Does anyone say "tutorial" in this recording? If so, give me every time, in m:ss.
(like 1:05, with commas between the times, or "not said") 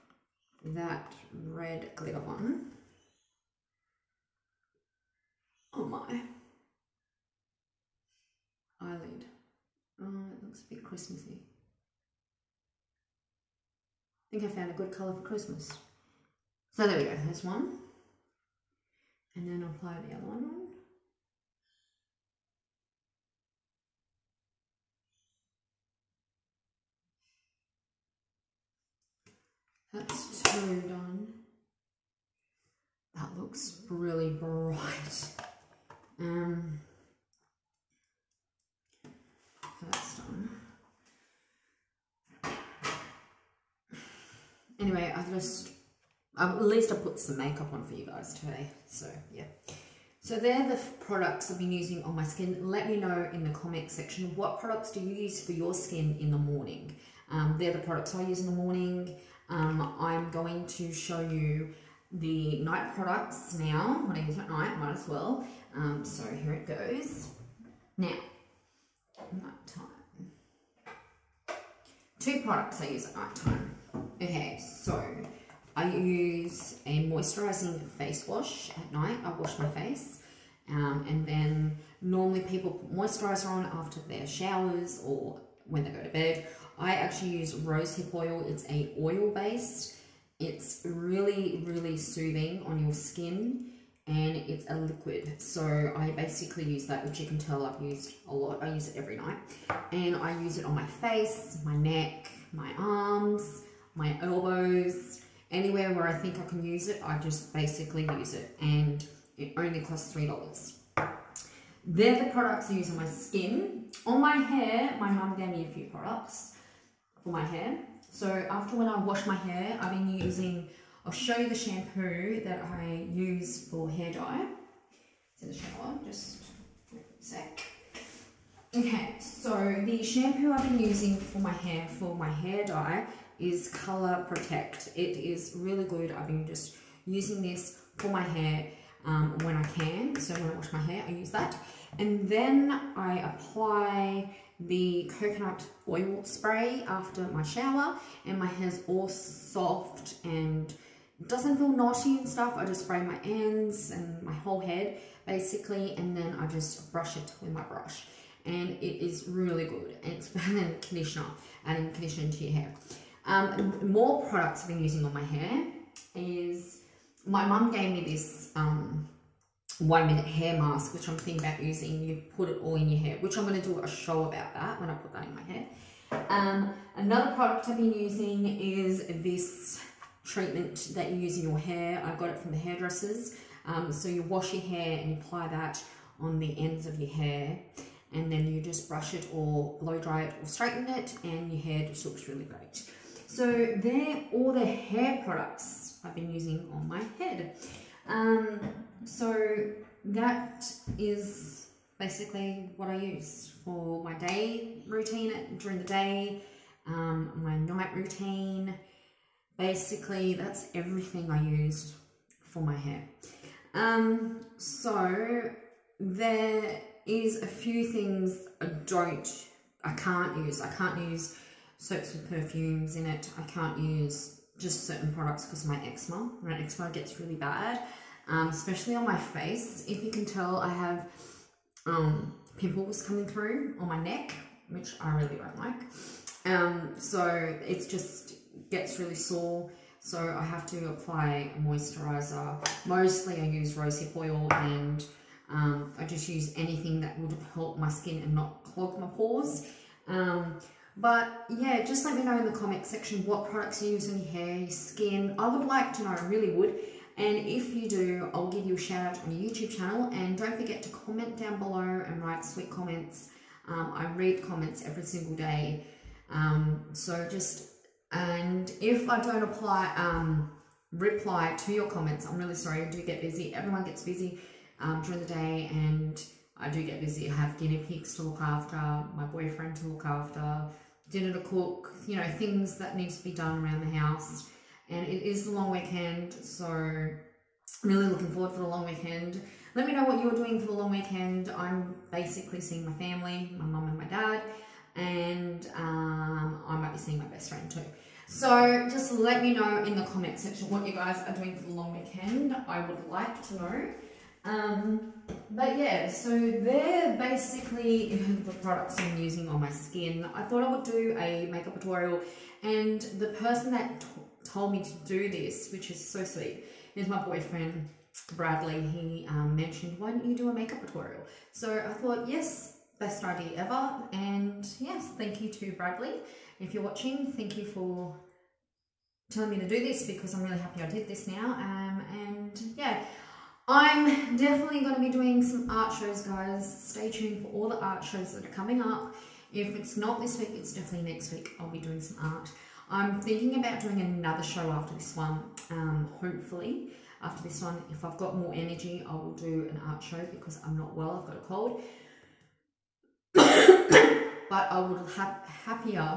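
5:11, 5:20.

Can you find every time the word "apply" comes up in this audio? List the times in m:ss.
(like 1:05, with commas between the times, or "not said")
0:19, 2:23, 3:05, 4:00, 4:29.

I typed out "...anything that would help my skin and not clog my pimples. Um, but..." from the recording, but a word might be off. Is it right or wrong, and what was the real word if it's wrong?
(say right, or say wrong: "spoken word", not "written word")
wrong: "pores", not "pimples".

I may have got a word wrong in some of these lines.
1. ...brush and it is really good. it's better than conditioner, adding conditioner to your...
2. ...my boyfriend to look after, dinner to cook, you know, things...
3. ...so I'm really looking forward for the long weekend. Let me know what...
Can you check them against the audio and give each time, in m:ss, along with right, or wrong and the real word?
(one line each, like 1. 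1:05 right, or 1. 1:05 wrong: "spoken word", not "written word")
1. 2:37 right
2. 4:39 right
3. 4:46 right.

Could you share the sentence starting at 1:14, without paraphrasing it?
Okay, so I use a moisturizing face wash at night.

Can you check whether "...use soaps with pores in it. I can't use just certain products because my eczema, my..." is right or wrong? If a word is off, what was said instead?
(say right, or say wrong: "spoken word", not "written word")
wrong: "perfumes", not "pores".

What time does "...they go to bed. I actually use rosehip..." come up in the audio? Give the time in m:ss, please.
1:25.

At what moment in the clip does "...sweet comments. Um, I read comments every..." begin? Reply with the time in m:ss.
4:22.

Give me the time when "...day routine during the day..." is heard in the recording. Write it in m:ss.
3:24.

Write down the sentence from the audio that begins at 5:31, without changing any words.
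Um, and yeah, I'm definitely going to be doing some art shows, guys.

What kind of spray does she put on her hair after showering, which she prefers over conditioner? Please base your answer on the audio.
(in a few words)
Coconut oil spray.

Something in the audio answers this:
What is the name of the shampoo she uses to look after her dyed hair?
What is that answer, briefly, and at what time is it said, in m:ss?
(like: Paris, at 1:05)
Color Protect, at 2:13.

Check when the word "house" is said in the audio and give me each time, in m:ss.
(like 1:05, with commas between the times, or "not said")
4:43.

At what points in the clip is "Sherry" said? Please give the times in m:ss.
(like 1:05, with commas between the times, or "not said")
not said.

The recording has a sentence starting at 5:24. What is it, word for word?
And yes, thank you to Bradley.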